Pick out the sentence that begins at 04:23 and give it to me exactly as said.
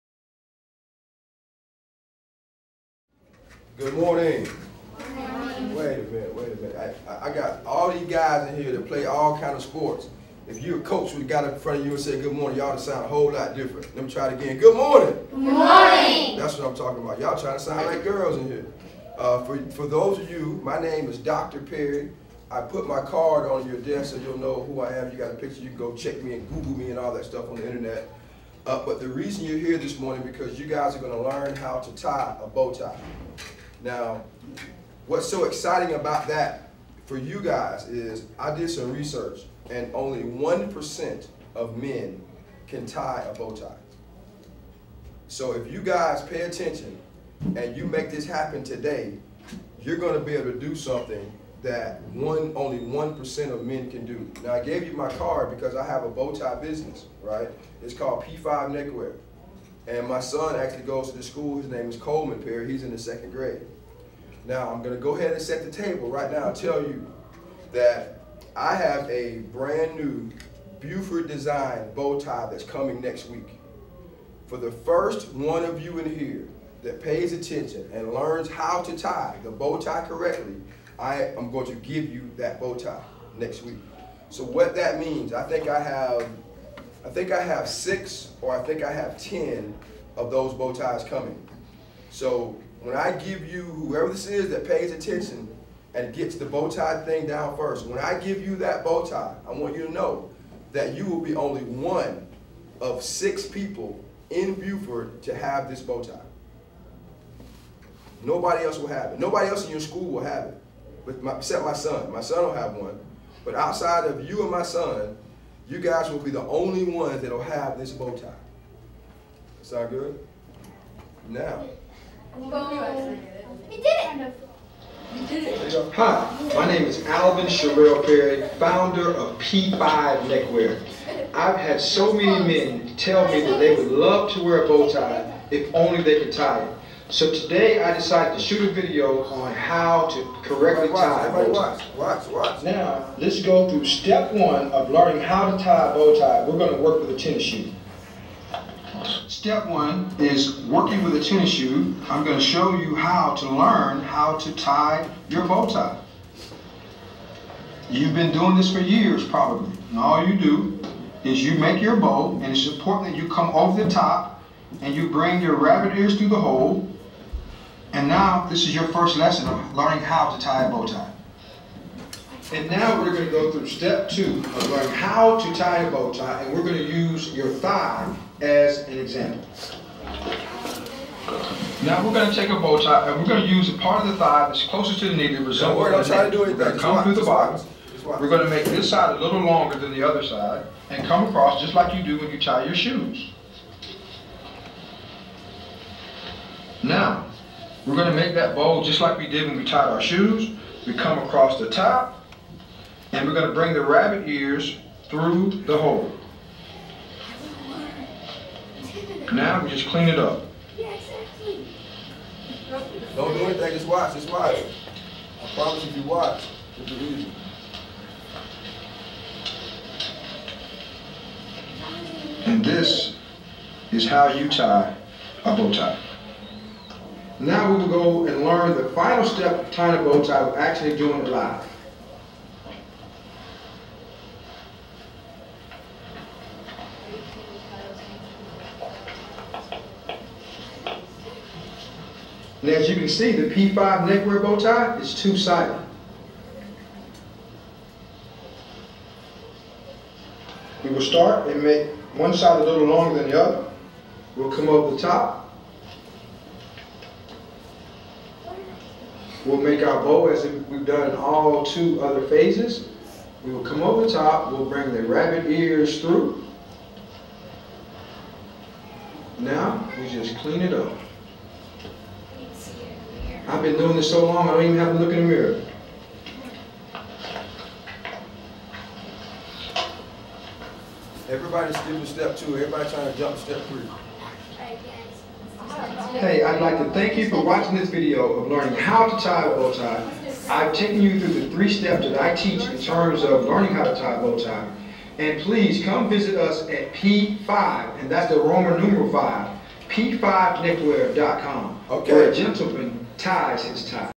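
We will come over top, we'll bring the rabbit ears through.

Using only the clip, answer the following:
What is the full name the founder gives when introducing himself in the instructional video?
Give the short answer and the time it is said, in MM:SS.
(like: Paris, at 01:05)
Alvin Sherrill Perry, at 02:07.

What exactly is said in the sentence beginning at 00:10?
If you're a coach we got in front of you and said good morning, y'all to sound a whole lot different.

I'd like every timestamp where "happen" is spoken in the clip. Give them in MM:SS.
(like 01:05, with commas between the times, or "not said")
00:48.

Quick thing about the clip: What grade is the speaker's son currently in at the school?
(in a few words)
second grade.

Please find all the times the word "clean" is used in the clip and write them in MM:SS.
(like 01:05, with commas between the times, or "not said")
03:29, 04:30.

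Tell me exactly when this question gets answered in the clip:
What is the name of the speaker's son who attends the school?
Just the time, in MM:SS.
01:01.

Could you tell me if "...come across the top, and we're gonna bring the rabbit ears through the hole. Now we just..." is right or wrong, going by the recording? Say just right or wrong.
right.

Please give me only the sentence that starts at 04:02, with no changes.
And as you can see, the P5 neckwear bow tie is two-sided.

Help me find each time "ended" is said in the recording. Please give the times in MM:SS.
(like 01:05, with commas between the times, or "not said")
not said.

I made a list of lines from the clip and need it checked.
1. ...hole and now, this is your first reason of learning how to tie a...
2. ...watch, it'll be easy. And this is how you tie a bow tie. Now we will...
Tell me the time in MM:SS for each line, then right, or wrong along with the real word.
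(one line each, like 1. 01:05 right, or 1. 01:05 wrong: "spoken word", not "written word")
1. 02:46 wrong: "lesson", not "reason"
2. 03:36 right.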